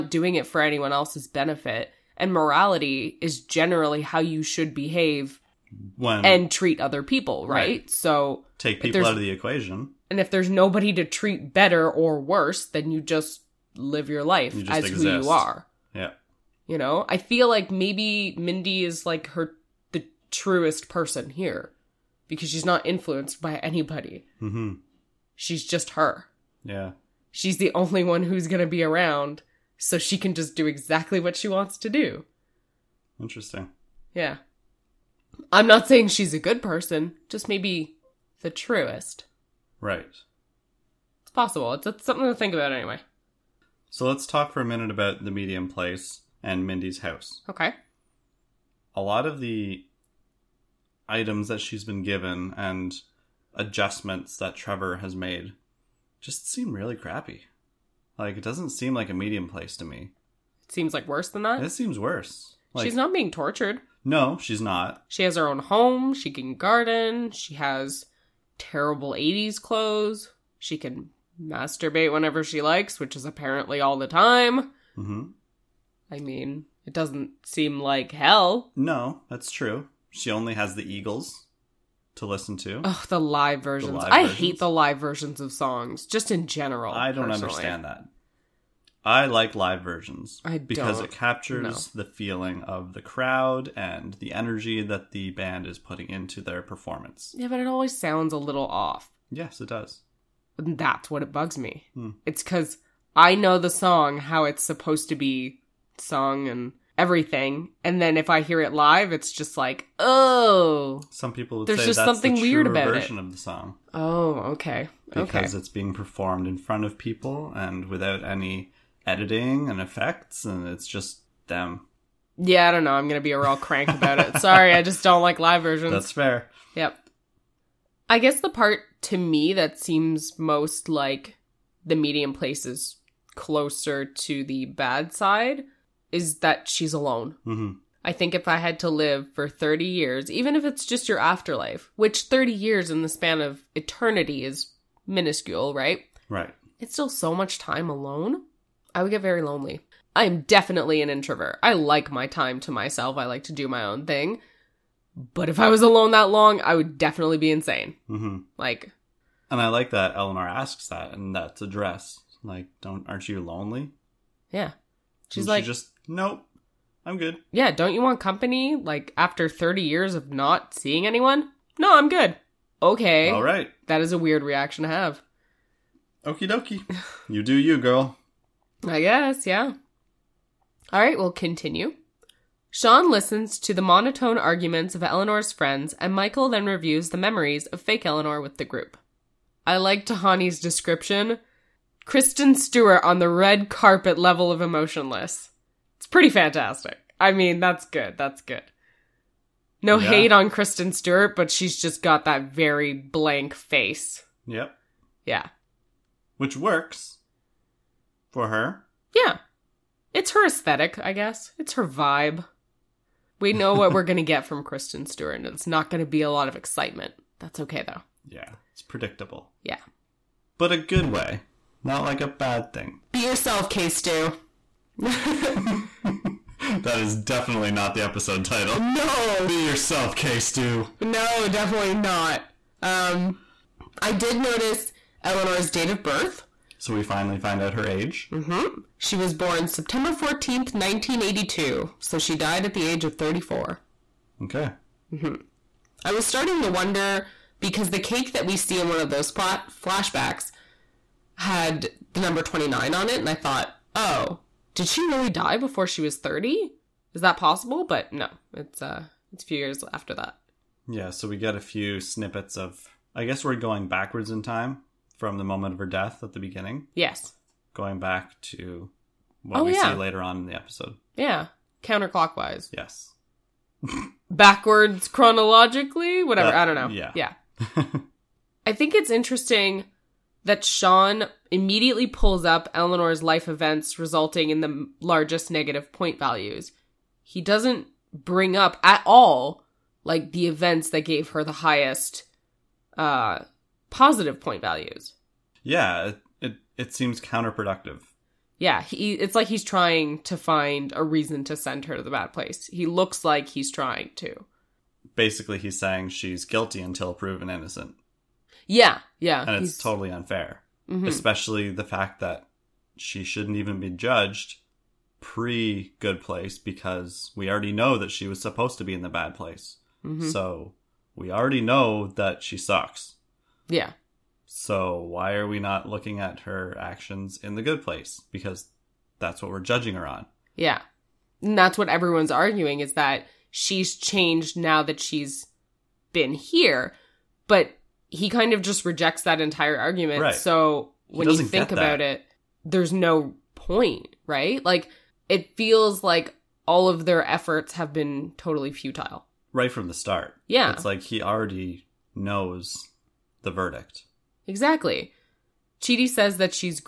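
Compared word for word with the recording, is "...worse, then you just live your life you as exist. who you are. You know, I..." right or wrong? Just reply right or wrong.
right.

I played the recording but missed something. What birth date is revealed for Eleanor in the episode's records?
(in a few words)
September 14th, 1982.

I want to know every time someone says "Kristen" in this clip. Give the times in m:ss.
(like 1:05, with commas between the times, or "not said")
3:12, 3:20, 3:34.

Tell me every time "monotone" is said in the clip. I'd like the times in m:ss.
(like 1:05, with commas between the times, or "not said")
3:03.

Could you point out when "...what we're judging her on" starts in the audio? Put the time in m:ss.
5:29.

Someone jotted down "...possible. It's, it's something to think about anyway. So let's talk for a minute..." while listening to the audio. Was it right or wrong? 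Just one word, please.
right.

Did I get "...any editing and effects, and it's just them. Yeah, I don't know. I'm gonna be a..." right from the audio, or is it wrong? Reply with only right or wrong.
right.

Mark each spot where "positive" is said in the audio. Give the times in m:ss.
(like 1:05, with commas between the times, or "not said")
4:53.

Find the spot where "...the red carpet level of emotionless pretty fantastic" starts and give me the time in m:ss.
3:13.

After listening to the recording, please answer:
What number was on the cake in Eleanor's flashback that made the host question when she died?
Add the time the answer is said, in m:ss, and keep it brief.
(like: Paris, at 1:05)
29, at 4:12.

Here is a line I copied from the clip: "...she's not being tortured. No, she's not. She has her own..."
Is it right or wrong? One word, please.
right.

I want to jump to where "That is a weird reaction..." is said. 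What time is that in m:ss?
2:53.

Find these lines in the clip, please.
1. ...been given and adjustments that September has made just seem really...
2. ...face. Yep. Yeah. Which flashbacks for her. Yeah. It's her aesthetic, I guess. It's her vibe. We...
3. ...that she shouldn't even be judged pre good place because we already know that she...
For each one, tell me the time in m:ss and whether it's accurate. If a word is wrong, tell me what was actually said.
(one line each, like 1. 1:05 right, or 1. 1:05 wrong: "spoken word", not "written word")
1. 0:51 wrong: "Trevor", not "September"
2. 3:23 wrong: "works", not "flashbacks"
3. 5:12 right.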